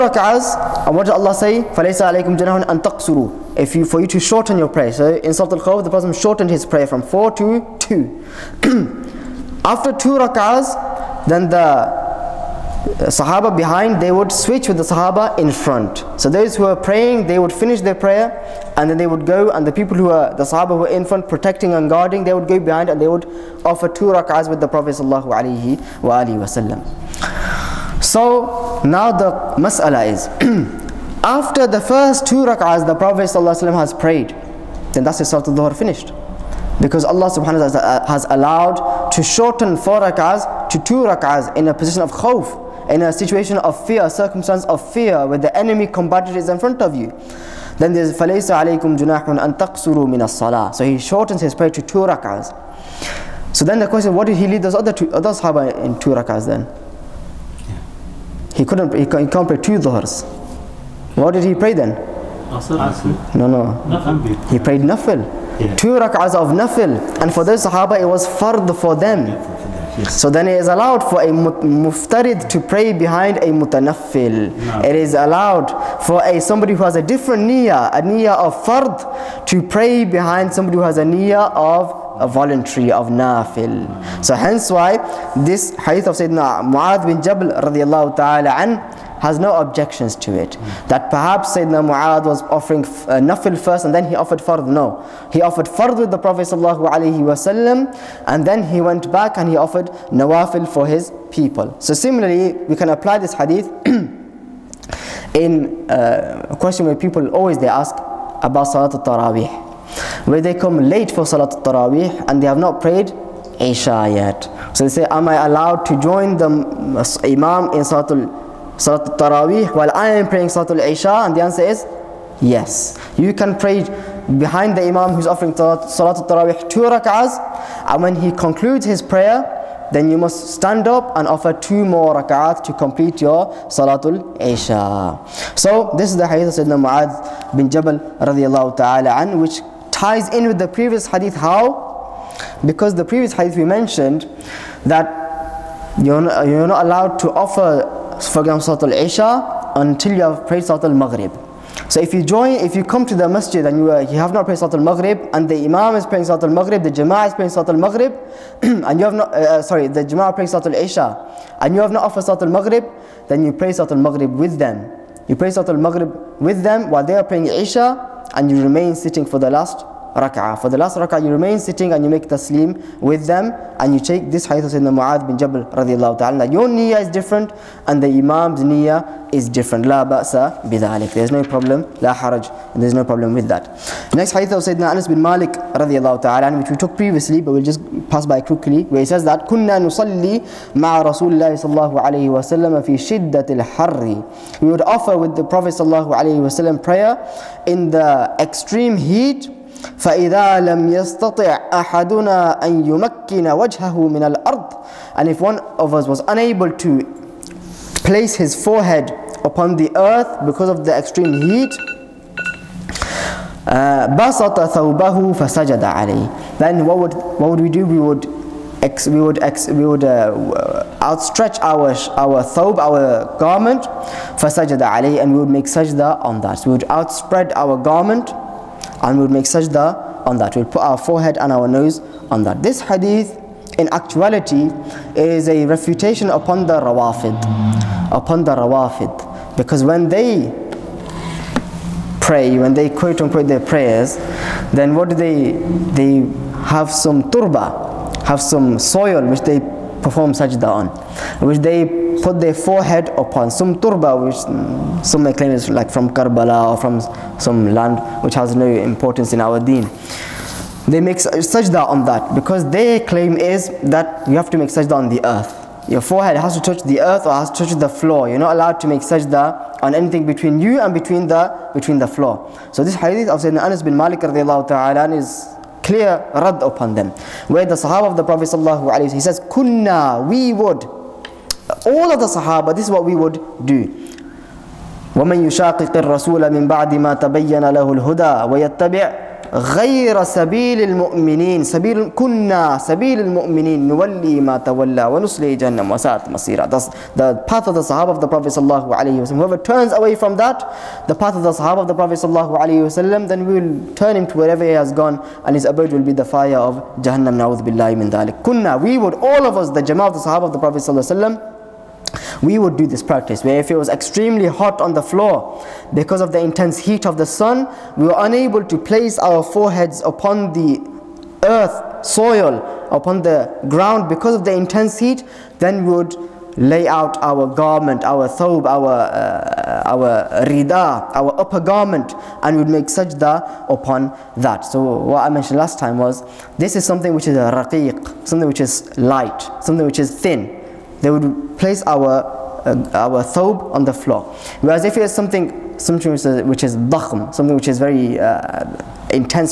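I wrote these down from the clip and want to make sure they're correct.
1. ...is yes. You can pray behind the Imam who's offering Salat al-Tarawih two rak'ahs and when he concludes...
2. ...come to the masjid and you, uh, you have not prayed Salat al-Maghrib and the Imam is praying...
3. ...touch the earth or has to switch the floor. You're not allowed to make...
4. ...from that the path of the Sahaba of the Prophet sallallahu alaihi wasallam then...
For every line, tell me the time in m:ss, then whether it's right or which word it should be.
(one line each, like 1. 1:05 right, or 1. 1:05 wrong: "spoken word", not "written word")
1. 2:01 right
2. 2:32 right
3. 4:26 wrong: "touch", not "switch"
4. 5:00 right.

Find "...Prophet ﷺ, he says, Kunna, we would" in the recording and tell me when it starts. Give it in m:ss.
4:38.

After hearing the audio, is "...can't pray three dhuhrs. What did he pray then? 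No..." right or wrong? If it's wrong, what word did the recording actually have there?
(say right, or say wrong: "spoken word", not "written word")
wrong: "two", not "three".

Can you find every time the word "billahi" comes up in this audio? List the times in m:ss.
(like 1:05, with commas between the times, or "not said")
5:07.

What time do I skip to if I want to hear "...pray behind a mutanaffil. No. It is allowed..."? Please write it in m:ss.
1:12.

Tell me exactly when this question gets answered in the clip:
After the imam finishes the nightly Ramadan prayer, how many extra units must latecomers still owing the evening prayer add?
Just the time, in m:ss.
2:11.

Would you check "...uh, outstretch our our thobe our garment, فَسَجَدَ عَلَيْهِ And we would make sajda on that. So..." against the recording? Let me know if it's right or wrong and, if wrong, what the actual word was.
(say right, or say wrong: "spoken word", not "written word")
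right.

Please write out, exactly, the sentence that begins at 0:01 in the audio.
فَلَيْسَ عَلَيْكُمْ جَنَاهٌ أَن تَقْصُرُوا If you, for you to shorten your prayer.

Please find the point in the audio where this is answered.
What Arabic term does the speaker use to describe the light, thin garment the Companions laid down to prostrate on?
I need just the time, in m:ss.
5:37.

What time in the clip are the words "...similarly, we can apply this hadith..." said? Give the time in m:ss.
1:41.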